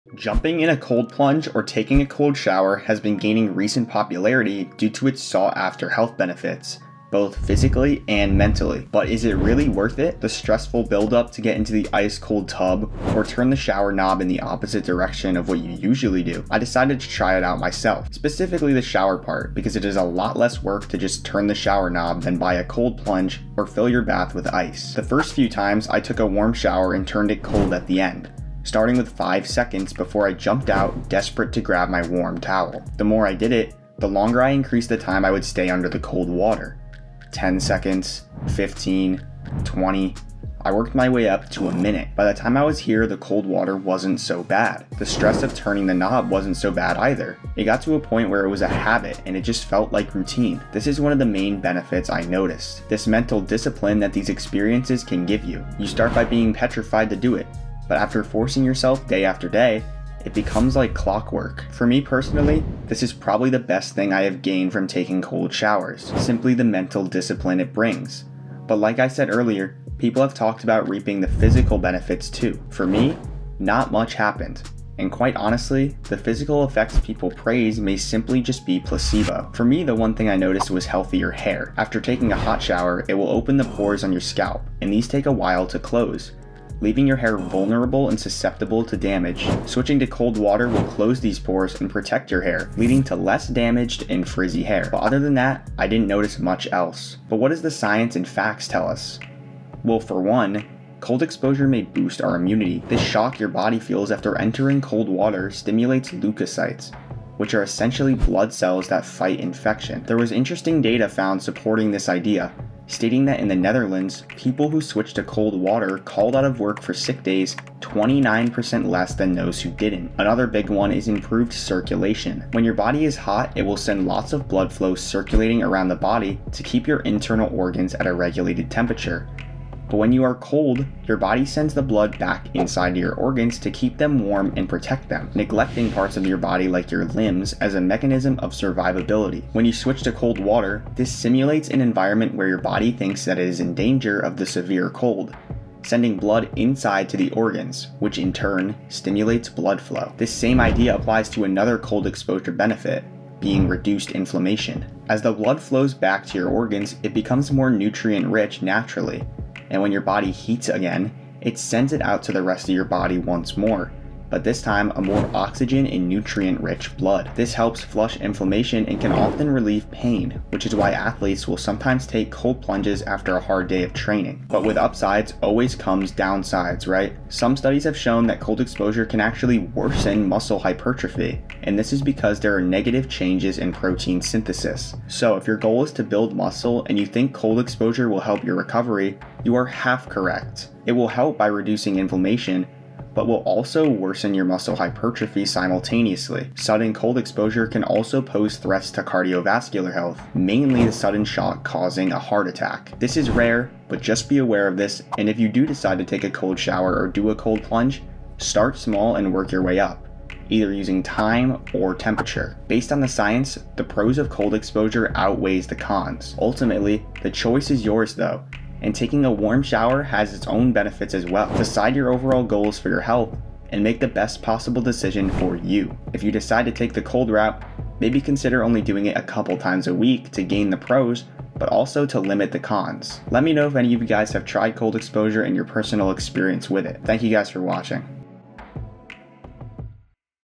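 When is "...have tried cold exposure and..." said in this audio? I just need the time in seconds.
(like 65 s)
234 s.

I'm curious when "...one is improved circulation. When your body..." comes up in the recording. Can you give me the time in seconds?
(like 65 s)
120 s.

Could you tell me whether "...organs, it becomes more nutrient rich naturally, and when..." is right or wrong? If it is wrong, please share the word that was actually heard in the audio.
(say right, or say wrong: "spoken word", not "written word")
right.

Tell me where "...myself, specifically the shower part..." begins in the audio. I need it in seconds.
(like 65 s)
17 s.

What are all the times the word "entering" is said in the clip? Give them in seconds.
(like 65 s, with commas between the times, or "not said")
104 s.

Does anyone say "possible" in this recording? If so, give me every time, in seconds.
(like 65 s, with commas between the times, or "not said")
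224 s.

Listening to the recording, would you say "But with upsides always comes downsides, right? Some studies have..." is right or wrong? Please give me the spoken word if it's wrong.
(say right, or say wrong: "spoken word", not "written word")
right.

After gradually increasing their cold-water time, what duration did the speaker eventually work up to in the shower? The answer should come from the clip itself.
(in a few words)
a minute.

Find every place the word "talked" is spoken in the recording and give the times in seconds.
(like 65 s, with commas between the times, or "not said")
70 s.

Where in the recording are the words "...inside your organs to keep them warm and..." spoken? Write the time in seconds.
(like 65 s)
132 s.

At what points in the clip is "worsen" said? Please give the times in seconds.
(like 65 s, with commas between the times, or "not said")
179 s, 193 s.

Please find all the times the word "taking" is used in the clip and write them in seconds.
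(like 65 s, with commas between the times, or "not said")
1 s, 64 s, 81 s, 218 s.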